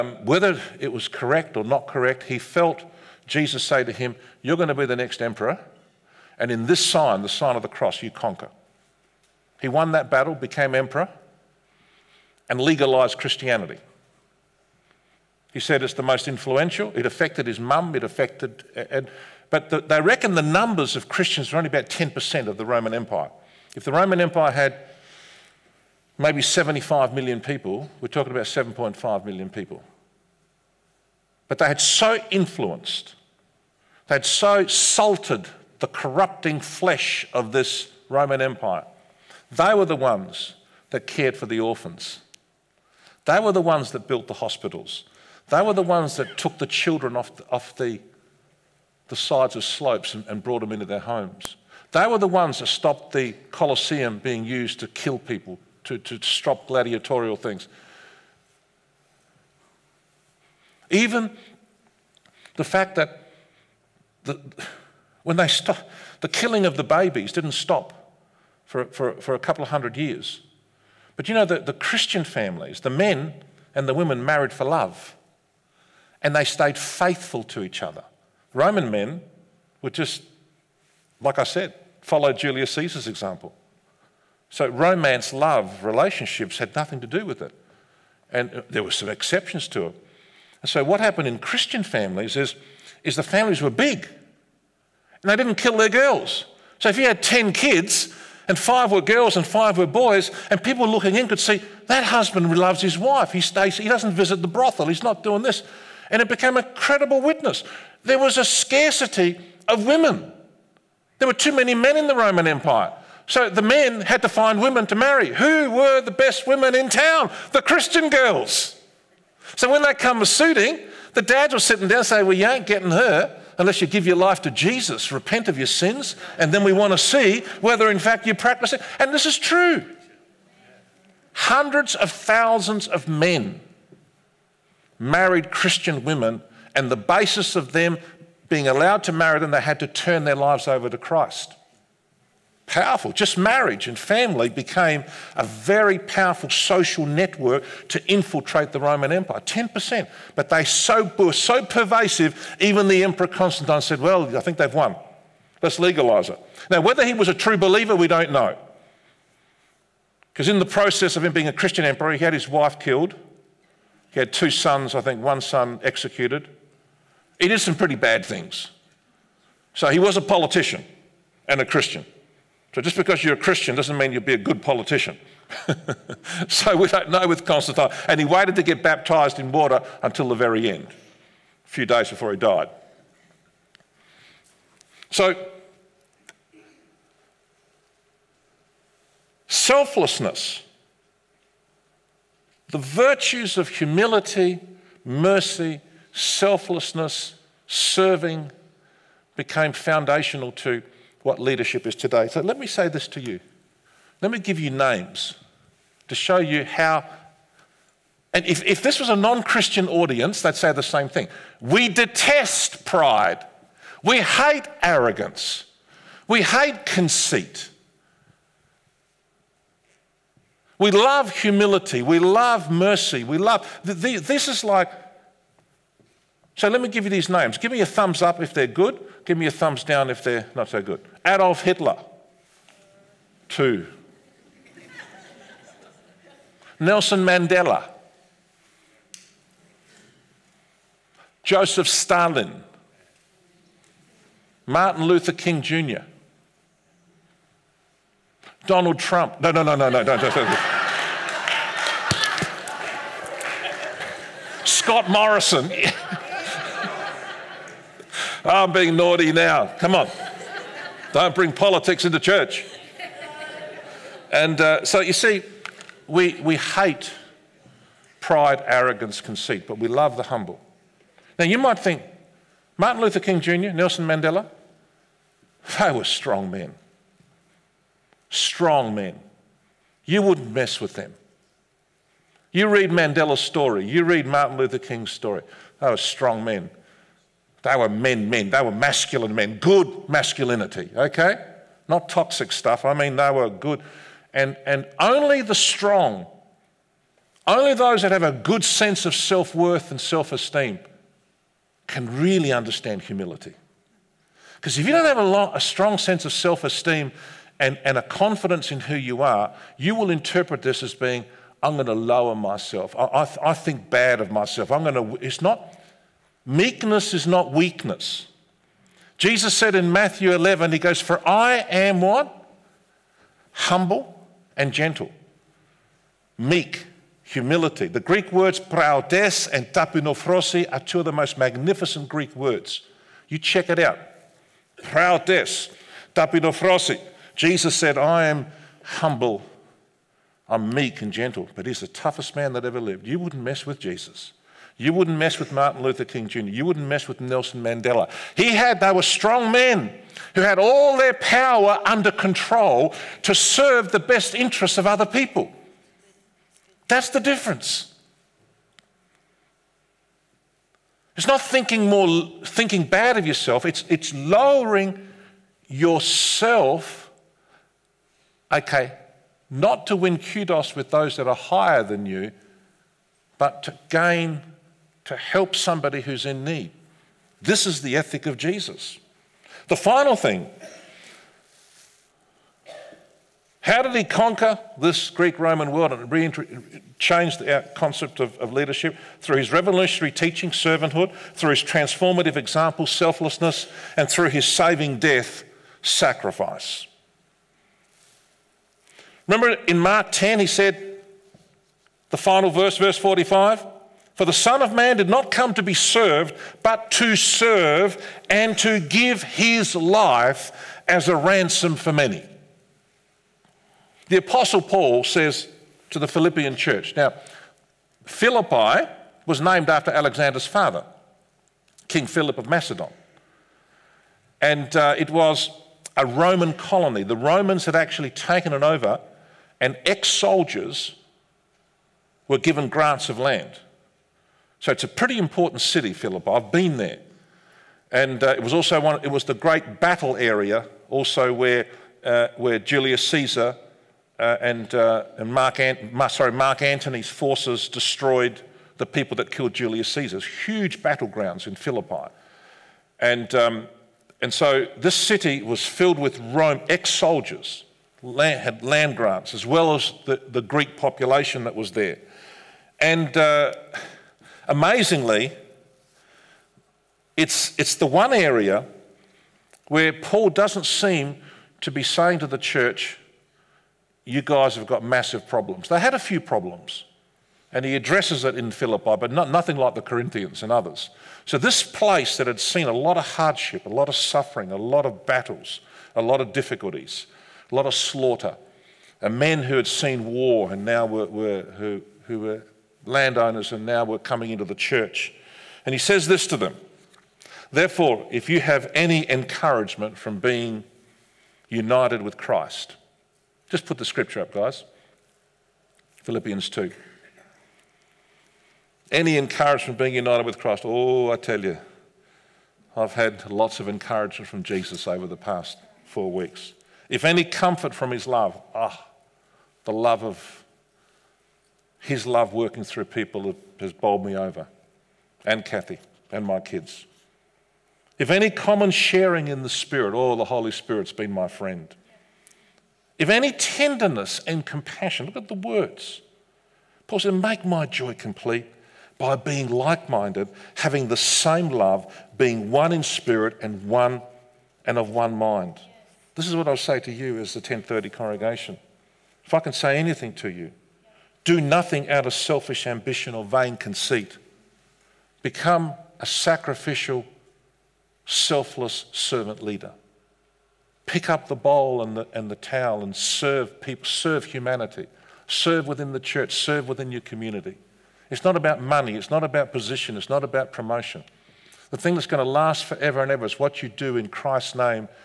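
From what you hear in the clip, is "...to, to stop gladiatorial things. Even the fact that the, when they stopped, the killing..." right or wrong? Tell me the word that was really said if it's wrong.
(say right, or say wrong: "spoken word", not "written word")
right.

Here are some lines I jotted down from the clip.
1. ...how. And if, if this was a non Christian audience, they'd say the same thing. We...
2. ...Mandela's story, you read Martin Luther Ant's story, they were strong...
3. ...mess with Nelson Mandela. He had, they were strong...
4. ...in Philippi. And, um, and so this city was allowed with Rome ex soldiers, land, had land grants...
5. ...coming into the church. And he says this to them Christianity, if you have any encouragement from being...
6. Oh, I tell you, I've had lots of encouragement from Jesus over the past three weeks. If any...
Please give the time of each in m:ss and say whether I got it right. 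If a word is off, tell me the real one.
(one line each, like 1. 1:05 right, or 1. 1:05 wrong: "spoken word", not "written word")
1. 3:26 right
2. 4:42 wrong: "King", not "Ant"
3. 5:46 right
4. 7:31 wrong: "filled", not "allowed"
5. 8:13 wrong: "Therefore", not "Christianity"
6. 8:30 wrong: "four", not "three".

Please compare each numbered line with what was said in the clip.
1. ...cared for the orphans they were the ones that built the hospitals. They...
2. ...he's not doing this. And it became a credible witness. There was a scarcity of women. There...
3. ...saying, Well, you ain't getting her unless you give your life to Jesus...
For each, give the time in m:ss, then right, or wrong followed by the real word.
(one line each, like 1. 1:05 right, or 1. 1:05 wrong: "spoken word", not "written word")
1. 0:41 right
2. 1:44 right
3. 2:02 right.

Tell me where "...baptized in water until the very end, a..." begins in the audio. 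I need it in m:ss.
2:58.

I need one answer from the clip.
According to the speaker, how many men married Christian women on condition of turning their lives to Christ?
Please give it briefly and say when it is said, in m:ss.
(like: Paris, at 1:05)
Hundreds of thousands, at 2:11.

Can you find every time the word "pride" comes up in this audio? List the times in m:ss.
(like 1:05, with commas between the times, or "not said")
3:32, 4:28.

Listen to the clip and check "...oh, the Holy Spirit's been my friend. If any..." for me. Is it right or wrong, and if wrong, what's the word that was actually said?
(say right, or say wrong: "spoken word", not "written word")
right.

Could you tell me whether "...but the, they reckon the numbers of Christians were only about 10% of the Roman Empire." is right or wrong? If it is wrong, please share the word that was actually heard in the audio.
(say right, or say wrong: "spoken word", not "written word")
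right.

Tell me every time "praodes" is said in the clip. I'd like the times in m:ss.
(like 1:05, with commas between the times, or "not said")
5:28, 5:34.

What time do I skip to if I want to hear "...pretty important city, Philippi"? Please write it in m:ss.
7:14.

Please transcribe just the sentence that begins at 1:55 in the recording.
Who were the best women in town?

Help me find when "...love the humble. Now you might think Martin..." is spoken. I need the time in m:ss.
4:29.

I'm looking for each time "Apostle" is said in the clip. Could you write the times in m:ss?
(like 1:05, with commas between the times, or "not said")
6:54.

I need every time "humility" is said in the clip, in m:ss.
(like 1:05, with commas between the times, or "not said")
3:13, 3:41, 5:03, 5:27.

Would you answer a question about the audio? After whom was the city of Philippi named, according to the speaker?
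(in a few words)
King Philip of Macedon.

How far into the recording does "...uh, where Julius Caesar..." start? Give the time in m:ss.
7:22.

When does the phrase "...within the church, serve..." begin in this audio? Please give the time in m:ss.
9:25.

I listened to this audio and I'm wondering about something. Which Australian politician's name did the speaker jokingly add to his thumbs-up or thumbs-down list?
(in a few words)
Scott Morrison.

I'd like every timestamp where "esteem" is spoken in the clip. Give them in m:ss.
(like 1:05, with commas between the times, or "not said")
5:00, 5:06.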